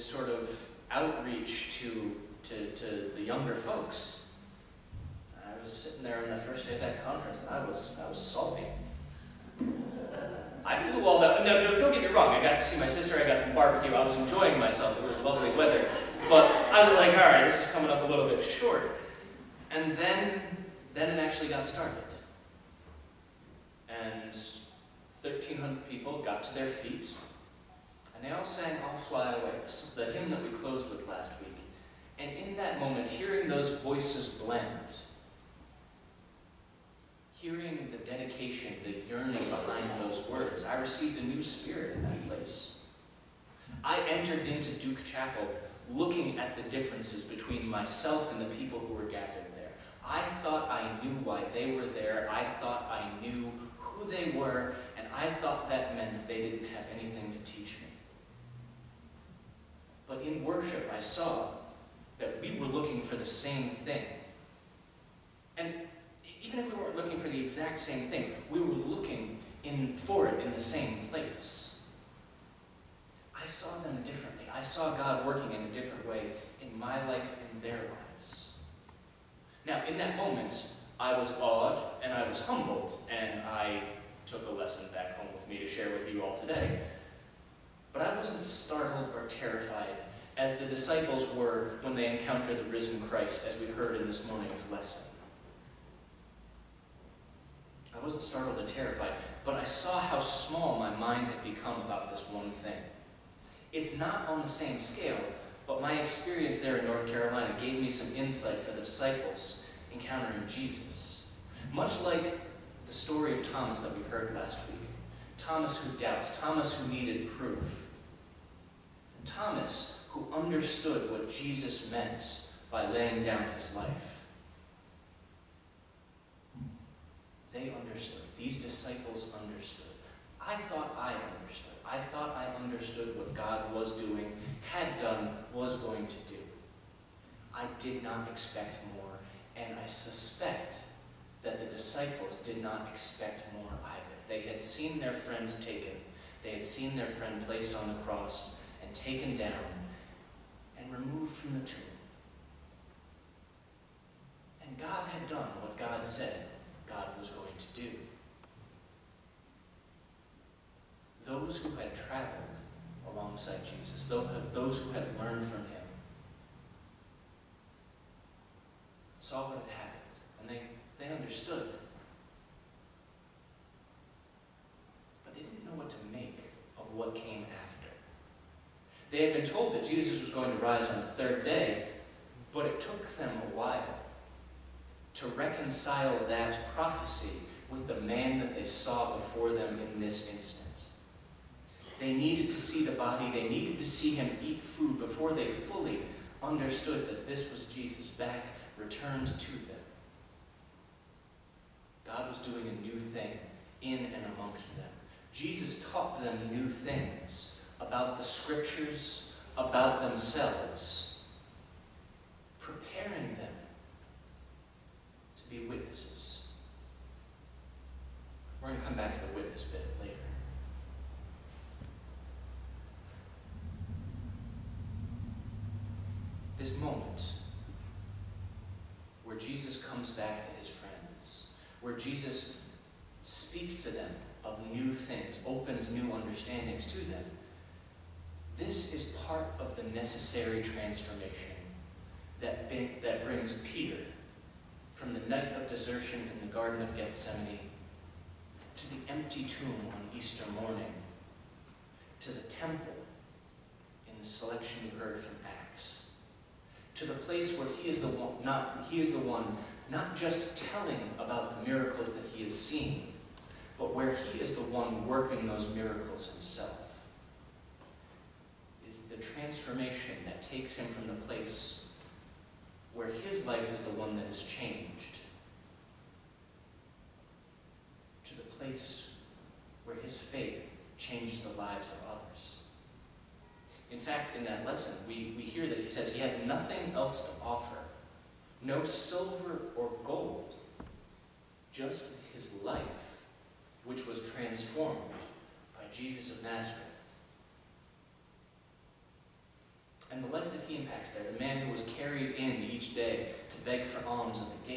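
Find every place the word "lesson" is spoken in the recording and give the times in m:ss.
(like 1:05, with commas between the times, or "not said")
1:24, 1:34, 4:44.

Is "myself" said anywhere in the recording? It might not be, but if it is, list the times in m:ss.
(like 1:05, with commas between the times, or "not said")
0:14, 0:47.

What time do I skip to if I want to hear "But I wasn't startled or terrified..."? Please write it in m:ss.
1:27.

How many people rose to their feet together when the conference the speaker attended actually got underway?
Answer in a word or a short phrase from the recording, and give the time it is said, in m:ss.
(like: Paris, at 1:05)
1,300, at 0:25.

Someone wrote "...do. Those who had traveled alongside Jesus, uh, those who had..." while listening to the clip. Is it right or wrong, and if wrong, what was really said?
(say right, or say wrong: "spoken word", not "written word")
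right.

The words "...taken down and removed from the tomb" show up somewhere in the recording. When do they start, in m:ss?
2:28.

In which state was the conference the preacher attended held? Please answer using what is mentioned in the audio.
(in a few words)
North Carolina.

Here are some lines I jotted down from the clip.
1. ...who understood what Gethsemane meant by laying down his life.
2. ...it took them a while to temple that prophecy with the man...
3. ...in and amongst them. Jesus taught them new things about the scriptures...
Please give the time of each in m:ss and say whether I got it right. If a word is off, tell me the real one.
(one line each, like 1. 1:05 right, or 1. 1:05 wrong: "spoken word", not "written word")
1. 2:00 wrong: "Jesus", not "Gethsemane"
2. 3:02 wrong: "reconcile", not "temple"
3. 3:23 right.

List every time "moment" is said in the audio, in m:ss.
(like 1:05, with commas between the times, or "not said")
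0:32, 1:20, 3:46.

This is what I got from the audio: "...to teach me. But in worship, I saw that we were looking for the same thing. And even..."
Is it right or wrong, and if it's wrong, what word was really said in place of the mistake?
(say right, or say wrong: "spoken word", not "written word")
right.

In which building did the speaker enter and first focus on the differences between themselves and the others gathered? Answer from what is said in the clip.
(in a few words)
Duke Chapel.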